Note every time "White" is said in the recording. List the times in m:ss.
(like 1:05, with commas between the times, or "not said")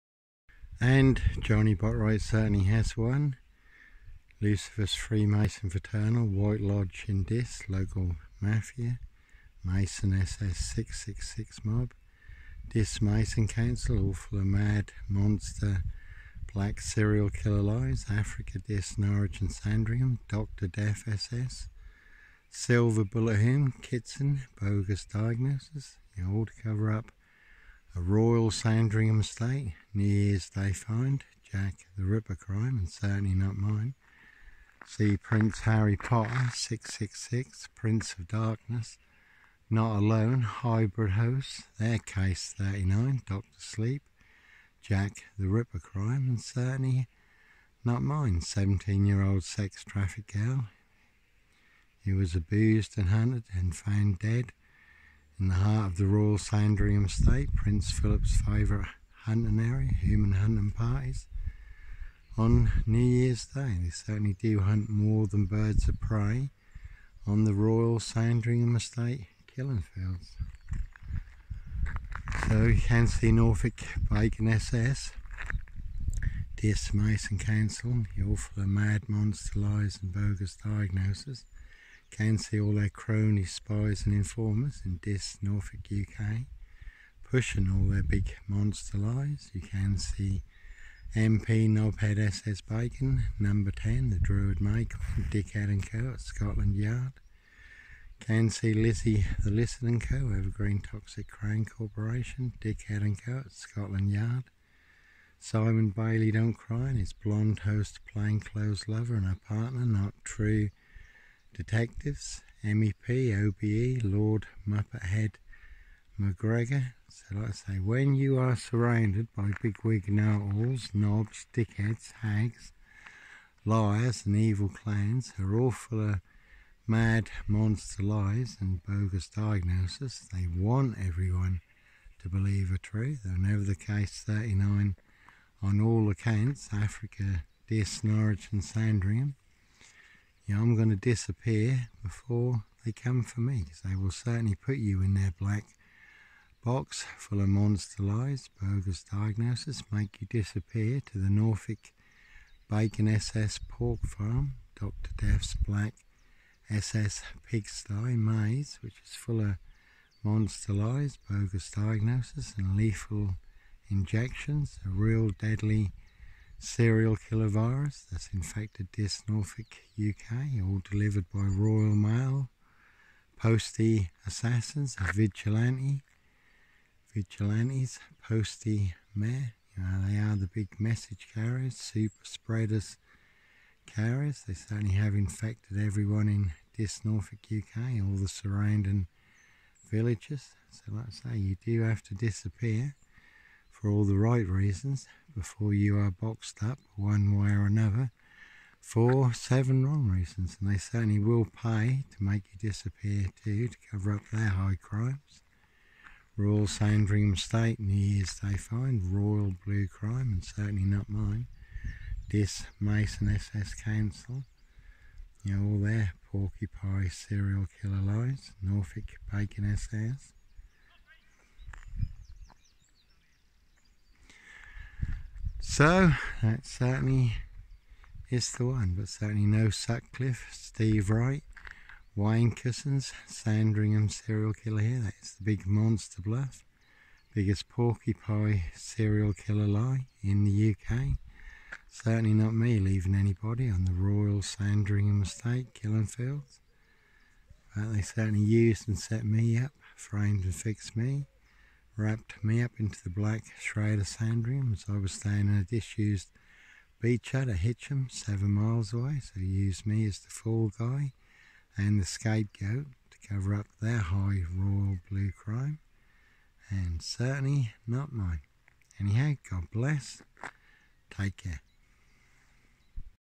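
0:06.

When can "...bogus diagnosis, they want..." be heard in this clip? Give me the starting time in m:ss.
2:08.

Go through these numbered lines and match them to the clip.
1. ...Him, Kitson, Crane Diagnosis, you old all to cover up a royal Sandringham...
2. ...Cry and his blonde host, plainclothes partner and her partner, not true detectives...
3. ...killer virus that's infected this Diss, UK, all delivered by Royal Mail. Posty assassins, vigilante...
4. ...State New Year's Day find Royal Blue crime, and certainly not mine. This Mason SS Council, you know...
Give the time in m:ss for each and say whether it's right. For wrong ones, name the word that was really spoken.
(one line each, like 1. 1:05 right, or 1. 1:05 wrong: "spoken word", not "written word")
1. 0:23 wrong: "Bogus", not "Crane"
2. 1:46 wrong: "lover", not "partner"
3. 2:47 wrong: "Norfolk", not "Diss"
4. 3:27 right.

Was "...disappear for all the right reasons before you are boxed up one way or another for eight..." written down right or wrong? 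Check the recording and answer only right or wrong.
wrong.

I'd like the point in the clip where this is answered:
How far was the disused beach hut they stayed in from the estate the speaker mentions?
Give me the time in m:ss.
4:18.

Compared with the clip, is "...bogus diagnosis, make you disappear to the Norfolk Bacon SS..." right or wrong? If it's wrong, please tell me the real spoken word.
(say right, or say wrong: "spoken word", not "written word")
right.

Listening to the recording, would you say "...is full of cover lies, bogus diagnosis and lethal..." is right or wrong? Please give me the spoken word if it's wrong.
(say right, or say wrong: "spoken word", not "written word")
wrong: "monster", not "cover".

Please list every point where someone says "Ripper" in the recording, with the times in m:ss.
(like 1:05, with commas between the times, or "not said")
0:32, 0:45.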